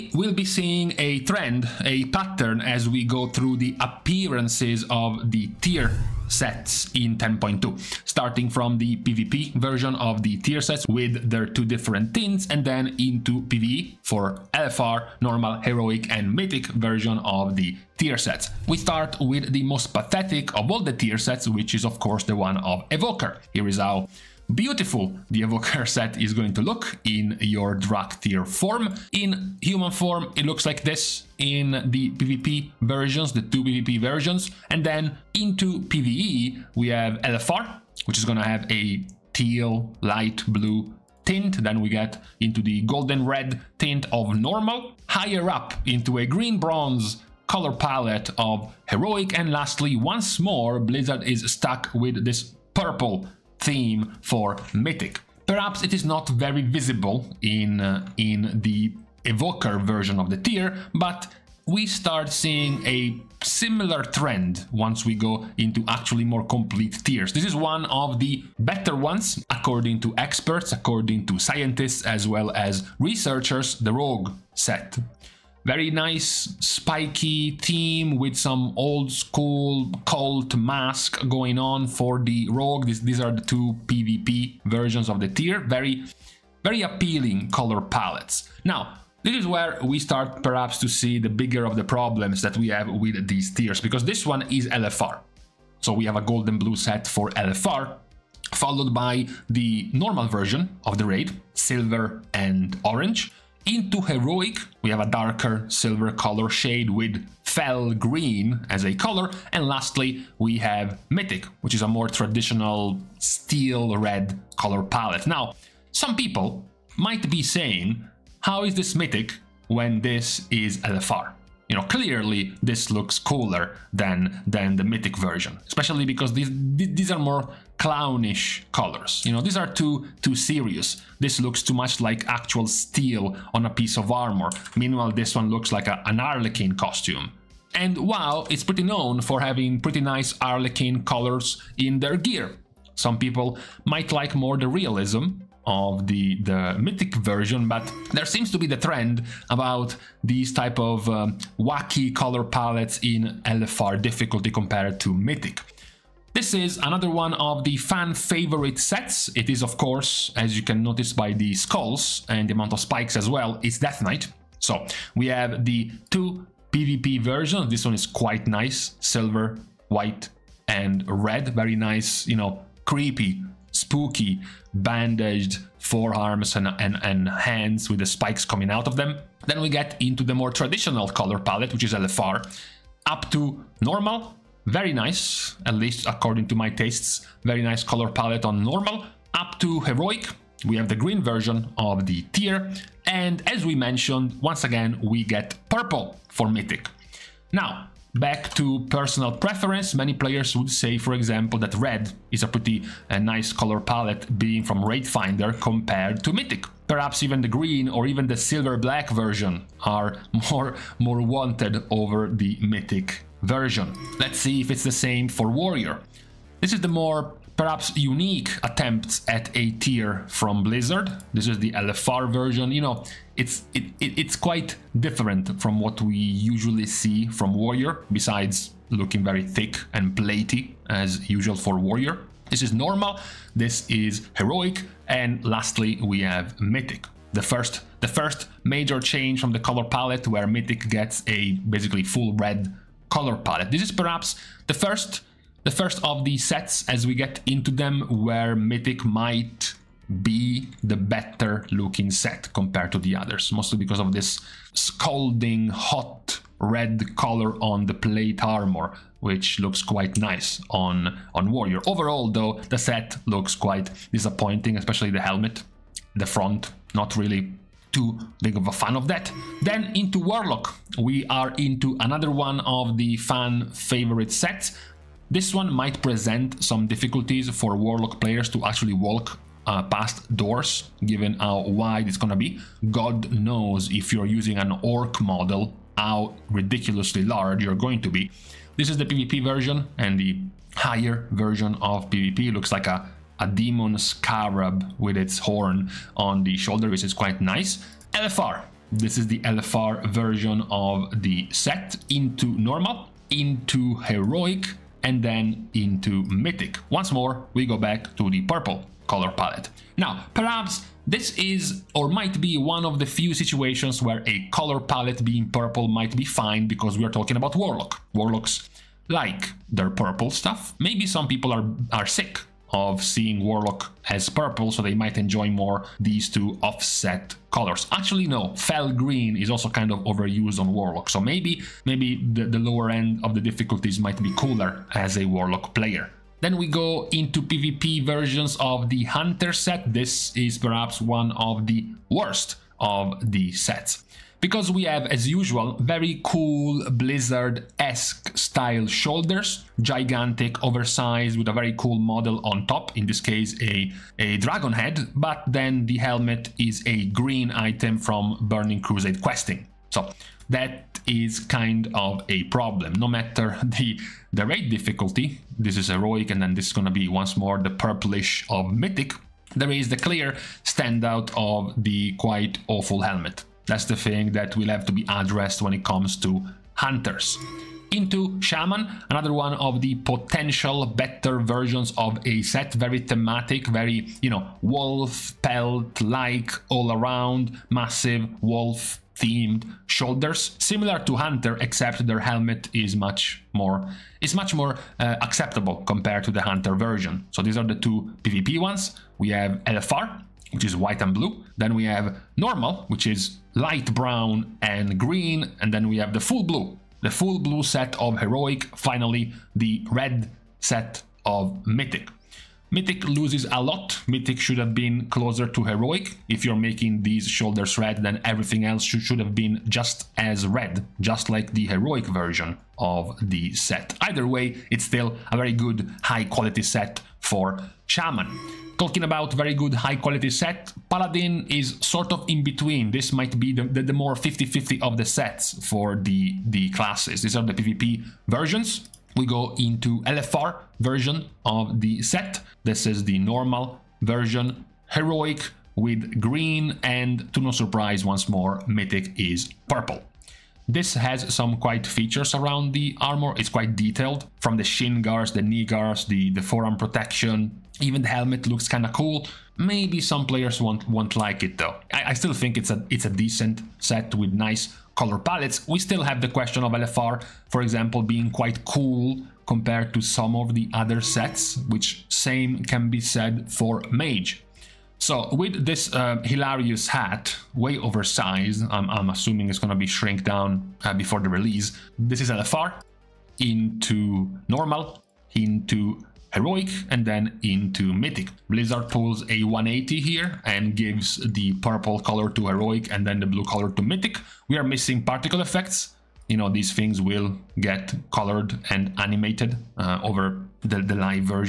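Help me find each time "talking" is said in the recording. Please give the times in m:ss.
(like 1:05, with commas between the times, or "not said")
5:17, 7:08.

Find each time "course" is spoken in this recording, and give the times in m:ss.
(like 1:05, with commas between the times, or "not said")
0:21, 2:39.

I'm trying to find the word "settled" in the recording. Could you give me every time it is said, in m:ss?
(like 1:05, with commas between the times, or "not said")
not said.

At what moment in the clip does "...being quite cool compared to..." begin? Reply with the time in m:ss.
7:48.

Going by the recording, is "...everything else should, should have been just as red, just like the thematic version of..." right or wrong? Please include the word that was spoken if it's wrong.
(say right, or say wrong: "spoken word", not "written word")
wrong: "heroic", not "thematic".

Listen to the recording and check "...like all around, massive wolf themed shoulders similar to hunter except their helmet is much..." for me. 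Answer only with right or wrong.
right.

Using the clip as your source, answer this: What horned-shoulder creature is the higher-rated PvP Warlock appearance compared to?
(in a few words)
A demon scarab.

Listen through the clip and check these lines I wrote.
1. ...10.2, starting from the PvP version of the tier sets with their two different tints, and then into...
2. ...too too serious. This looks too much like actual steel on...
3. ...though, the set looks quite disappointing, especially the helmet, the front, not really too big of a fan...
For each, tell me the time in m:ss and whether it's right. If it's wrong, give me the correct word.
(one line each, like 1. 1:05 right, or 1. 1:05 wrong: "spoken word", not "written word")
1. 0:07 right
2. 2:09 right
3. 4:22 right.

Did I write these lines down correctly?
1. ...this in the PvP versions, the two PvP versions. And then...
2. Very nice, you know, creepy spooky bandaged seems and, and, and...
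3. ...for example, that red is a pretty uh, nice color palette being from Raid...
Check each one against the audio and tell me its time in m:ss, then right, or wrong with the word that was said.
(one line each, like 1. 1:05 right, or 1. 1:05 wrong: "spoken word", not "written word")
1. 0:30 right
2. 2:51 wrong: "forearms", not "seems"
3. 3:20 right.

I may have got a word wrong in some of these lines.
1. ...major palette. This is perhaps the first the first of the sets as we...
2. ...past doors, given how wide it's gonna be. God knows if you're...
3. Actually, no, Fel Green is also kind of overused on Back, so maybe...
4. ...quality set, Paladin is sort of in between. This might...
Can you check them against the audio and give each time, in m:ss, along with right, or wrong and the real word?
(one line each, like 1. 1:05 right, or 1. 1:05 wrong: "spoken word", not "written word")
1. 4:03 wrong: "color", not "major"
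2. 4:39 right
3. 5:27 wrong: "Warlock", not "Back"
4. 7:09 right.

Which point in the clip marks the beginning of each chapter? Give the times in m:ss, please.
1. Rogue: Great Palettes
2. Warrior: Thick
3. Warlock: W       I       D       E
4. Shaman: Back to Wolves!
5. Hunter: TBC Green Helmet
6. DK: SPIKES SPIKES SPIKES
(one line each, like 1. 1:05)
1. 1:02
2. 3:33
3. 4:29
4. 6:16
5. 5:36
6. 2:27.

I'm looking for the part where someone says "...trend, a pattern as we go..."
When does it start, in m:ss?
0:01.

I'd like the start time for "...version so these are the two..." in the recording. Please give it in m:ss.
6:36.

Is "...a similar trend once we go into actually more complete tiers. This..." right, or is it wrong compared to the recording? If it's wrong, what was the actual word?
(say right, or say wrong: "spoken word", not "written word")
right.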